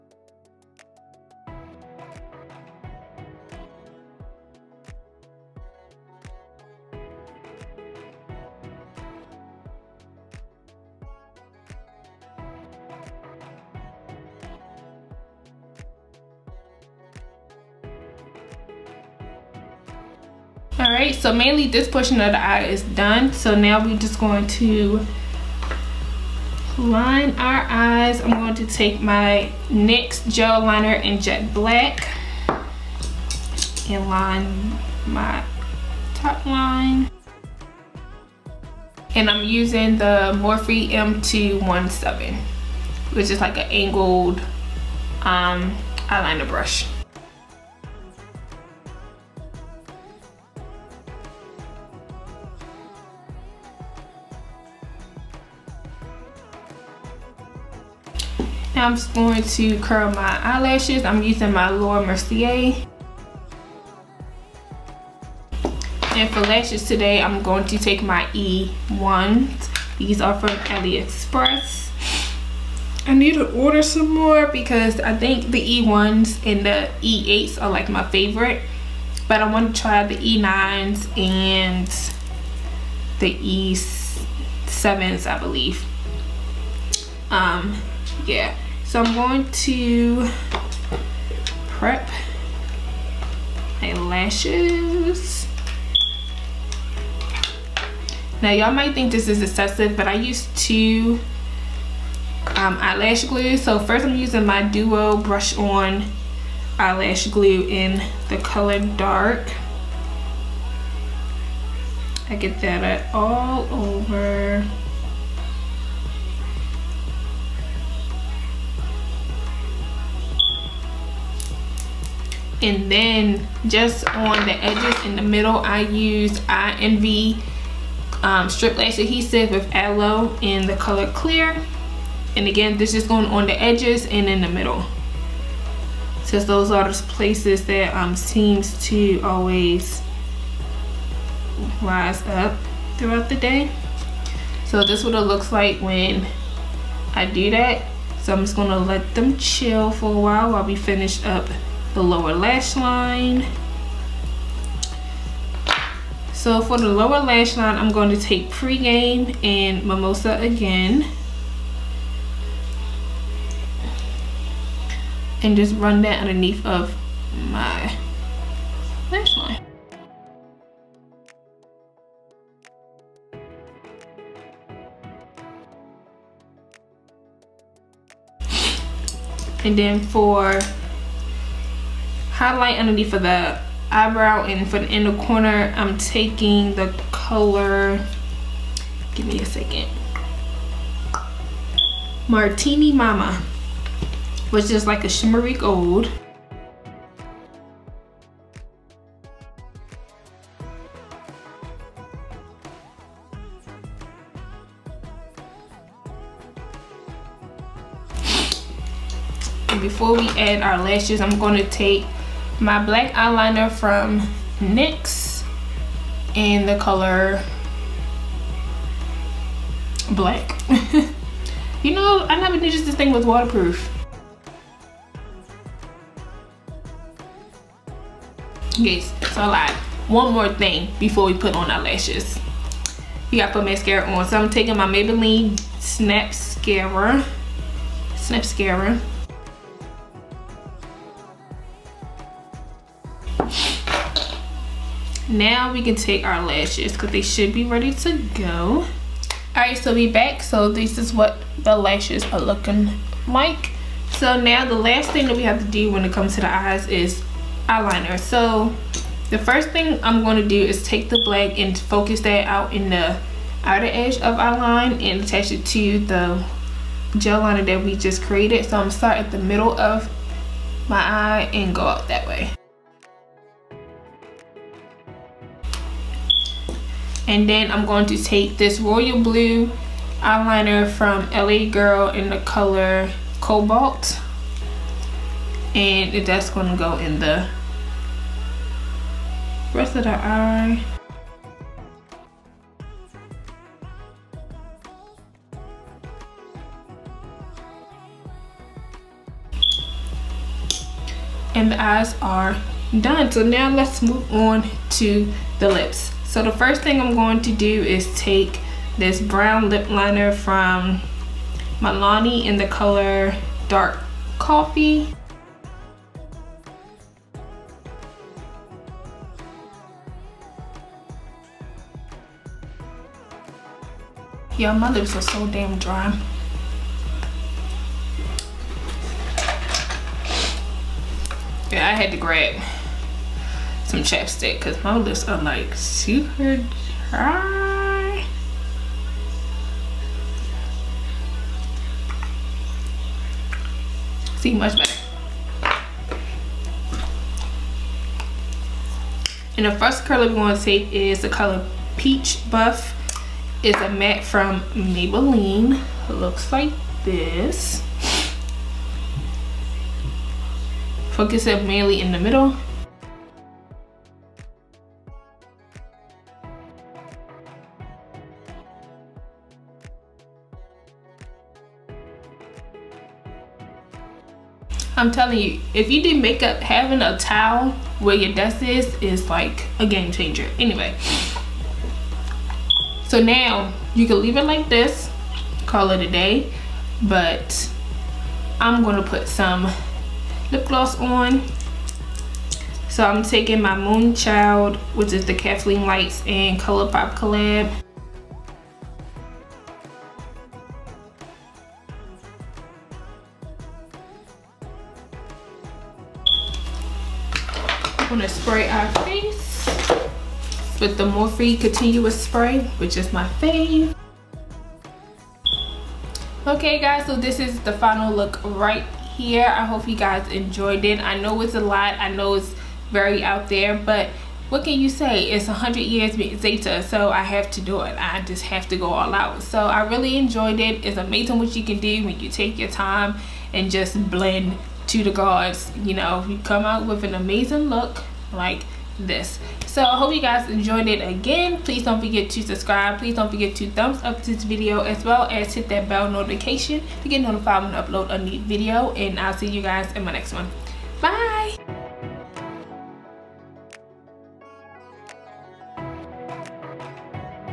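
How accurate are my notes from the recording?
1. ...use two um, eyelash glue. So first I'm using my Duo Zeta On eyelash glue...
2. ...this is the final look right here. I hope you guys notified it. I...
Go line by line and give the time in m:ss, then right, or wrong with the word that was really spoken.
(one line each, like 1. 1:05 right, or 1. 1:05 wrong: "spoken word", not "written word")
1. 1:40 wrong: "Brush", not "Zeta"
2. 6:57 wrong: "enjoyed", not "notified".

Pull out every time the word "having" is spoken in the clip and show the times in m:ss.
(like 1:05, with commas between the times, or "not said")
6:16.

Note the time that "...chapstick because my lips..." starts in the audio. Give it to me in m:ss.
5:34.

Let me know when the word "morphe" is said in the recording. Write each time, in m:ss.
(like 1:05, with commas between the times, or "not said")
0:40, 6:51.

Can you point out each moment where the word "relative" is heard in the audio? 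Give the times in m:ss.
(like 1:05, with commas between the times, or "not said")
not said.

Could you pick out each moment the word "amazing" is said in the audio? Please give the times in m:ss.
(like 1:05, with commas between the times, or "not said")
7:10, 7:17.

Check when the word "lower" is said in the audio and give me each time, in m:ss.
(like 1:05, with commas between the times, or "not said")
2:32, 2:36.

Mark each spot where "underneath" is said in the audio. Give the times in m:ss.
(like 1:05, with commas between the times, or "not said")
2:46, 3:02.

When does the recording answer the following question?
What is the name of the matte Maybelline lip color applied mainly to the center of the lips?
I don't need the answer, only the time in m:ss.
5:51.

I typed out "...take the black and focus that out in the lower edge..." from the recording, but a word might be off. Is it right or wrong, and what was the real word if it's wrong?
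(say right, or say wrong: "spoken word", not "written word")
wrong: "outer", not "lower".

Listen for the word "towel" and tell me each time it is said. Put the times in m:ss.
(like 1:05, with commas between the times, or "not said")
6:17.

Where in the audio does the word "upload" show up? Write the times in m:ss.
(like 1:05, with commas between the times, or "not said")
7:27.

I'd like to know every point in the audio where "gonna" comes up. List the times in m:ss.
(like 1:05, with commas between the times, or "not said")
2:28, 4:28, 6:28.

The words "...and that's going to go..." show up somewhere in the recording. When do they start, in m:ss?
4:45.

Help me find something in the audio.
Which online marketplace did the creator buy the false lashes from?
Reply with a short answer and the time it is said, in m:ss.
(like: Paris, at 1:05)
AliExpress, at 1:10.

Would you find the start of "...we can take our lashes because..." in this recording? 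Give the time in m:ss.
4:05.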